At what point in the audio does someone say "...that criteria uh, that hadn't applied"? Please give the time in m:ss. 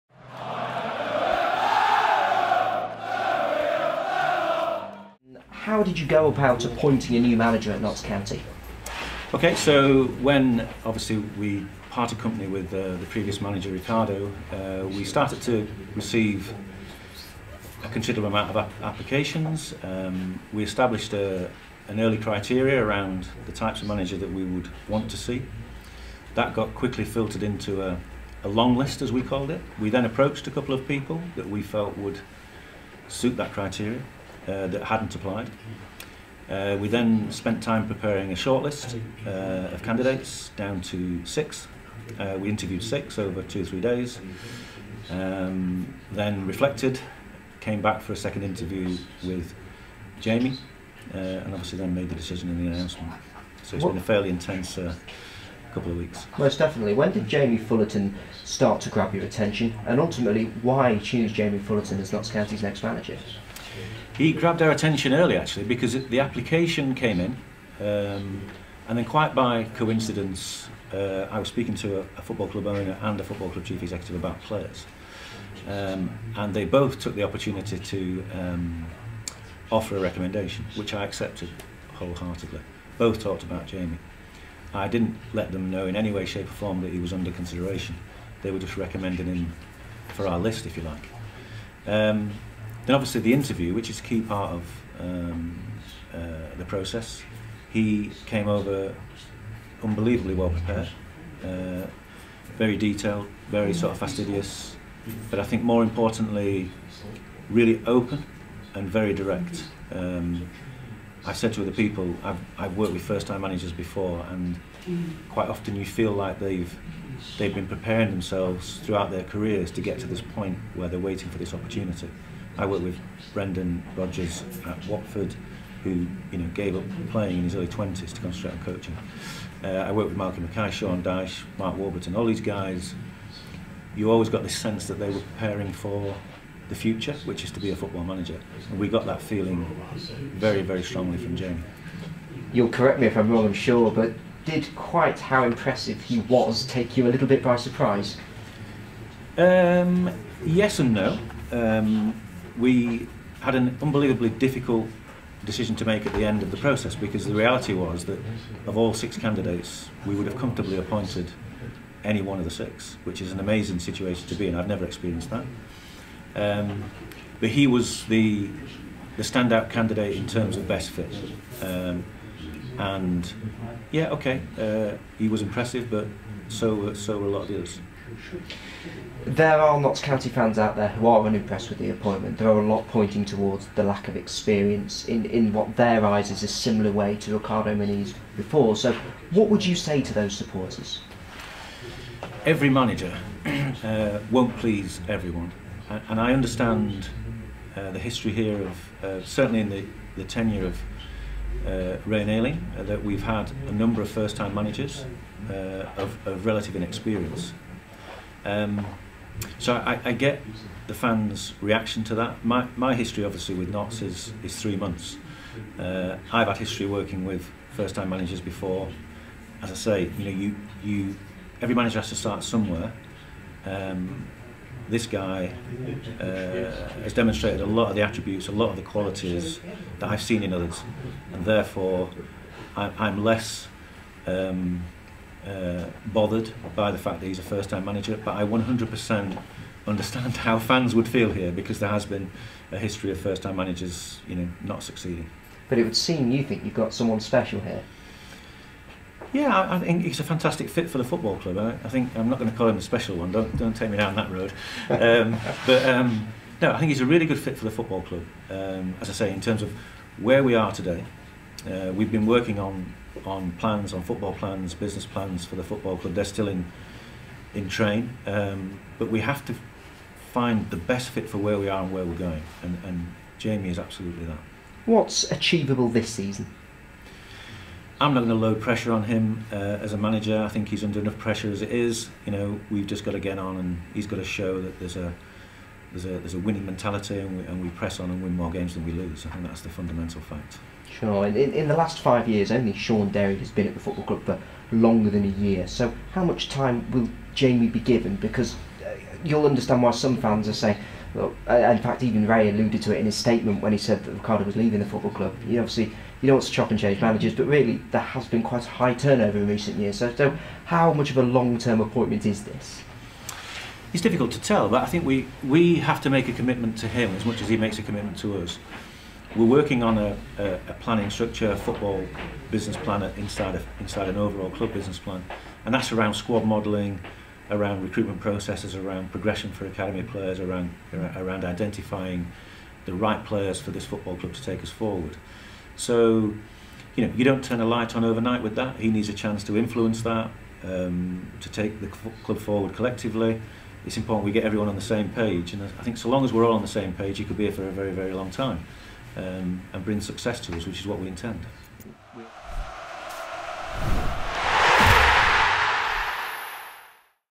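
0:33.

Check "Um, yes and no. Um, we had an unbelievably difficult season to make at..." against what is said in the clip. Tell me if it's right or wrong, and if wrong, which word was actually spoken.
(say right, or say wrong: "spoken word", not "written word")
wrong: "decision", not "season".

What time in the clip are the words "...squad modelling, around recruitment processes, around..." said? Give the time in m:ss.
5:26.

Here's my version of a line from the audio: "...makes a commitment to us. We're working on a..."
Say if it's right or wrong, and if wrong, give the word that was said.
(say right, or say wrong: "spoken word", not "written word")
right.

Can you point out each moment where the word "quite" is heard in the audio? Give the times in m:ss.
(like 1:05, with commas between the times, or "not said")
1:09, 1:55, 2:24, 5:08.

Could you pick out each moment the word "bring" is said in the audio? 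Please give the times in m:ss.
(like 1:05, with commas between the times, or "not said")
5:49.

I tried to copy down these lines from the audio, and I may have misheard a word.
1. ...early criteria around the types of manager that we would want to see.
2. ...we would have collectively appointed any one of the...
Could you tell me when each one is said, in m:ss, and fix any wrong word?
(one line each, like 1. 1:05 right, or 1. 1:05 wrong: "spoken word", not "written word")
1. 0:21 right
2. 2:40 wrong: "comfortably", not "collectively".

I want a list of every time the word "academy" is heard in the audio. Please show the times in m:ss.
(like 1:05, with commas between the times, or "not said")
5:29.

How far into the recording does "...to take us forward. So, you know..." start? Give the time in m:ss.
5:34.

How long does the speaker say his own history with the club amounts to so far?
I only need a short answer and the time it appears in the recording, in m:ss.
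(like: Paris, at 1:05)
3 months, at 3:34.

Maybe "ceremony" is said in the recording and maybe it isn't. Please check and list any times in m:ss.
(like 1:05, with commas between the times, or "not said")
not said.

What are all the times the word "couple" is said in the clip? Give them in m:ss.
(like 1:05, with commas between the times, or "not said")
0:30, 0:55.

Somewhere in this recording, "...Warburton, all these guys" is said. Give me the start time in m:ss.
2:11.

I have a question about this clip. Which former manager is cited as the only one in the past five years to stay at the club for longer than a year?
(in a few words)
Sean Derry.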